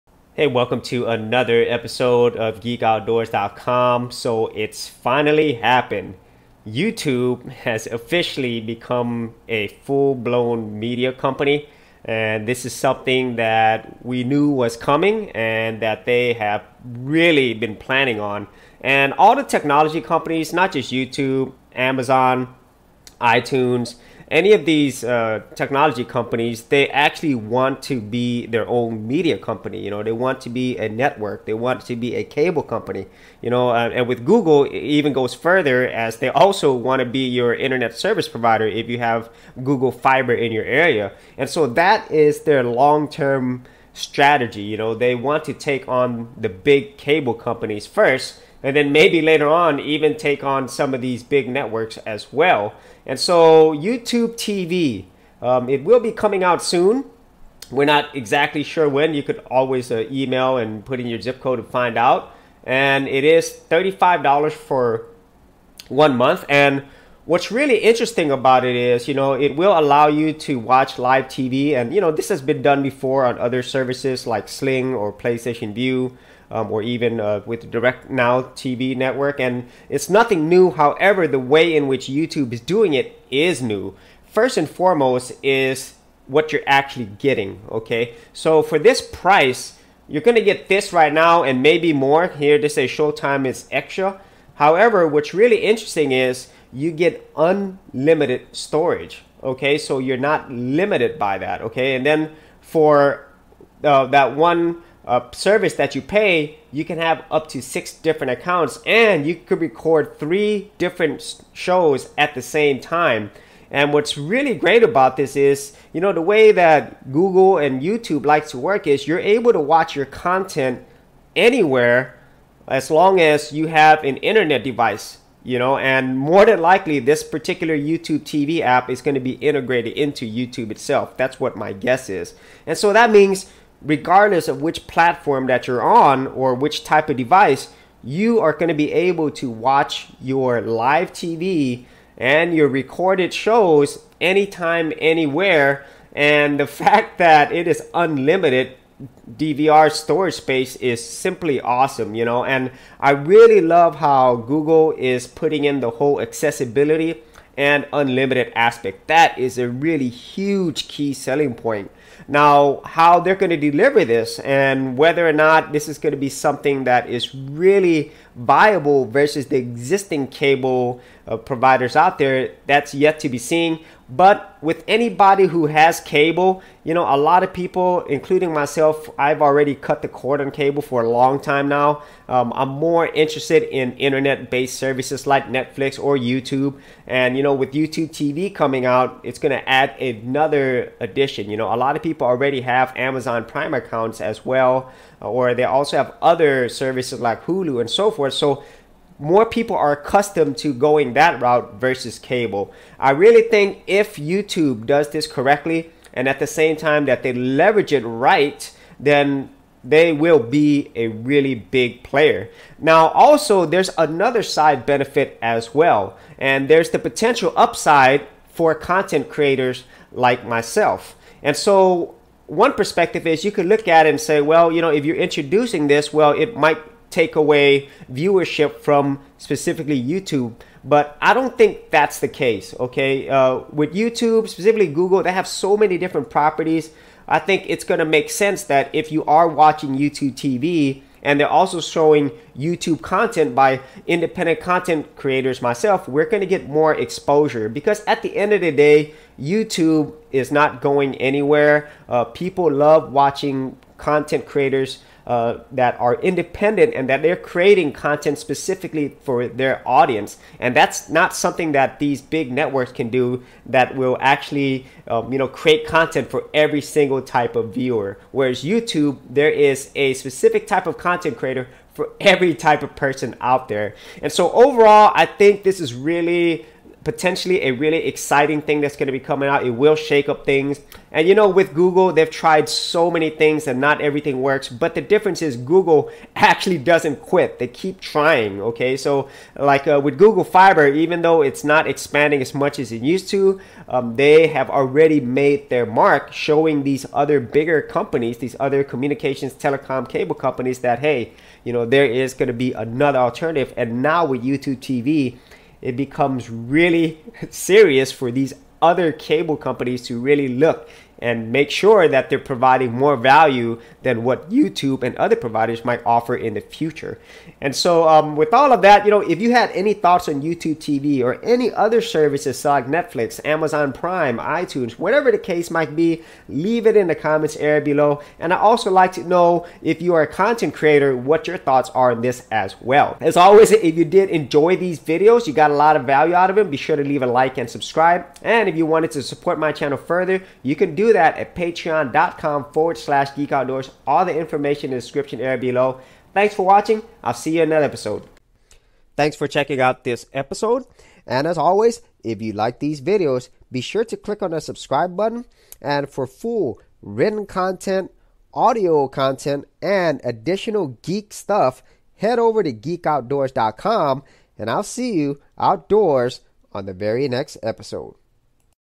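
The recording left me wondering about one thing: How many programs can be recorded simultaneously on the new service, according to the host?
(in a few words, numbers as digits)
3.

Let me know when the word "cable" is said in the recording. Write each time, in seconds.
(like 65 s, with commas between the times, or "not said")
32 s, 46 s, 170 s, 175 s, 180 s, 202 s, 300 s, 309 s.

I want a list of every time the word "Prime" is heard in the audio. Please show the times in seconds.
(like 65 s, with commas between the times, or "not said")
193 s, 323 s.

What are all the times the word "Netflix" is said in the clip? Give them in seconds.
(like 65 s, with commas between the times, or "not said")
185 s, 322 s.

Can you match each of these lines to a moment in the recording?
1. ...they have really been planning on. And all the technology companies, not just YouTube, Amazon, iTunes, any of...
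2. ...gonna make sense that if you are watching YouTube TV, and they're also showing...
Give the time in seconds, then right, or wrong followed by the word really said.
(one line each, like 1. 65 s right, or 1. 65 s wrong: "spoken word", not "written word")
1. 16 s right
2. 237 s right.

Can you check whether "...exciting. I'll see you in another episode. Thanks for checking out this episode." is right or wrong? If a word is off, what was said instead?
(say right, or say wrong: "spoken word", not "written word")
wrong: "watching", not "exciting".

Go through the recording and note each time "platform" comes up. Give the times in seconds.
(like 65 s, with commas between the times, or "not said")
134 s.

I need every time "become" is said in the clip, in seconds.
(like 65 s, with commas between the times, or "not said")
8 s, 305 s.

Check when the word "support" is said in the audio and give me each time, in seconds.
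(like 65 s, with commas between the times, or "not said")
339 s.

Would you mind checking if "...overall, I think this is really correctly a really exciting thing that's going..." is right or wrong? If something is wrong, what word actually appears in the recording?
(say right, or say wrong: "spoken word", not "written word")
wrong: "potentially", not "correctly".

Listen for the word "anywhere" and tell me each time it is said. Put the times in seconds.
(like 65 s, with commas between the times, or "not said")
121 s, 144 s, 251 s.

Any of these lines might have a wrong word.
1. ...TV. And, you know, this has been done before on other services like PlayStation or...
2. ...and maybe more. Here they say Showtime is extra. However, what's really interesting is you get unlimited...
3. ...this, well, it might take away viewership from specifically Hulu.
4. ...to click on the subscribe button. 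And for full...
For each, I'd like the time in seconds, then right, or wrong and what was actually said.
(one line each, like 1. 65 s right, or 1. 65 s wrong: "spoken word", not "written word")
1. 71 s wrong: "Sling", not "PlayStation"
2. 91 s right
3. 225 s wrong: "YouTube", not "Hulu"
4. 354 s right.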